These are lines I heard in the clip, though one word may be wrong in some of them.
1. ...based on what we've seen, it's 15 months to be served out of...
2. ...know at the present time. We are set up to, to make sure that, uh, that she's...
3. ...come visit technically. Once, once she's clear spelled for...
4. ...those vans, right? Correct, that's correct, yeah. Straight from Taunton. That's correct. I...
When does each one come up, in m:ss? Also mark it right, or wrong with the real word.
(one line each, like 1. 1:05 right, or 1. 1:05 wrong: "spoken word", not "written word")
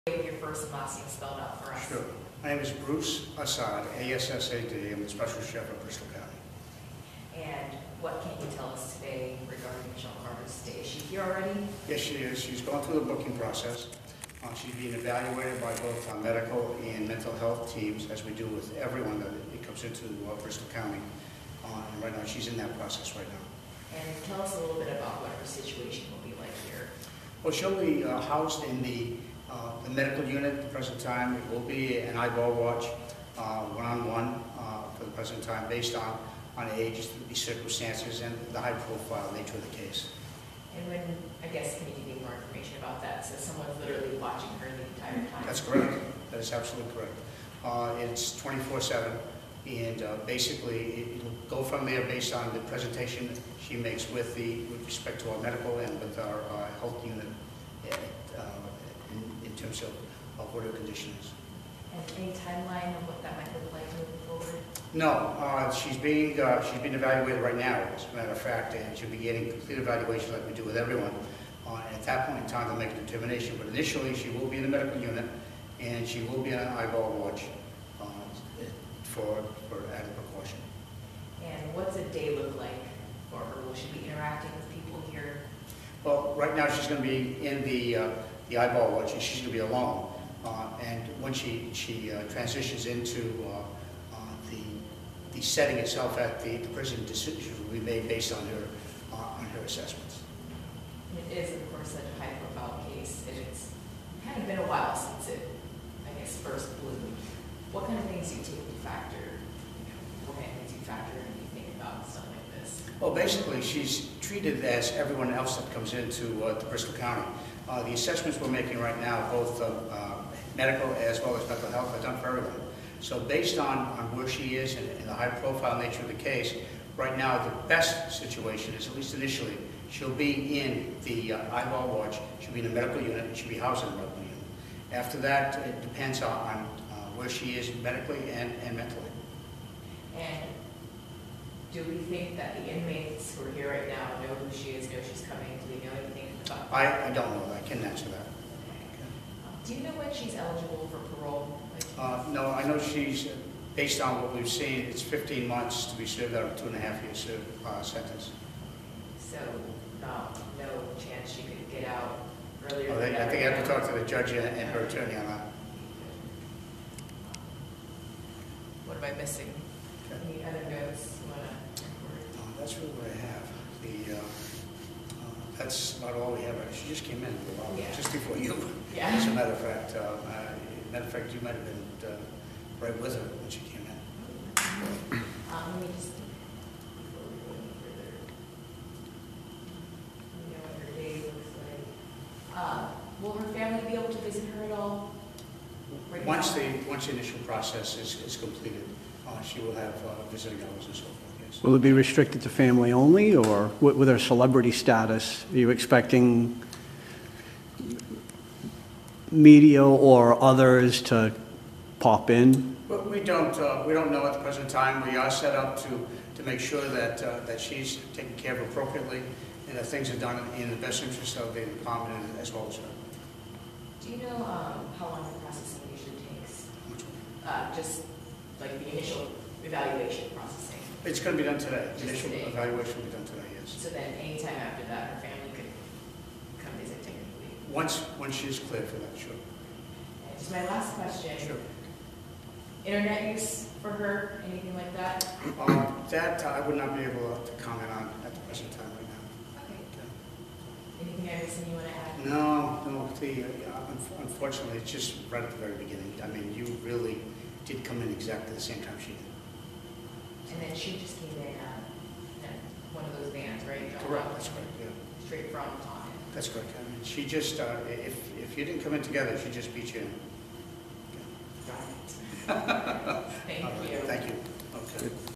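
1. 2:33 right
2. 3:34 right
3. 3:56 wrong: "cleared", not "spelled"
4. 4:23 right.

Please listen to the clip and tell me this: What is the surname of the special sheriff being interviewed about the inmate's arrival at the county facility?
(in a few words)
Assad.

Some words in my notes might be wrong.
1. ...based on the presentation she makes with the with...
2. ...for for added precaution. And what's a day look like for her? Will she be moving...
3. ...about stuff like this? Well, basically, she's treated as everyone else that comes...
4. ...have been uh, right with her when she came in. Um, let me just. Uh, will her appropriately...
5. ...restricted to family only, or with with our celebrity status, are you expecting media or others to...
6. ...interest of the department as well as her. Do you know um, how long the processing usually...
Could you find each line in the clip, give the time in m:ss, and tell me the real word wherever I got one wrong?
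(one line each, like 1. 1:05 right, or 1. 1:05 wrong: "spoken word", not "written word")
1. 0:52 right
2. 1:19 wrong: "interacting", not "moving"
3. 1:51 right
4. 3:01 wrong: "family", not "appropriately"
5. 3:21 right
6. 3:41 right.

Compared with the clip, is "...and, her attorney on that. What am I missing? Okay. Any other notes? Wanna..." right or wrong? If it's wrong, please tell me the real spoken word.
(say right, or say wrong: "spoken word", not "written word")
right.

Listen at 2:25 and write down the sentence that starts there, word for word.
Do we know anything I, I don't know.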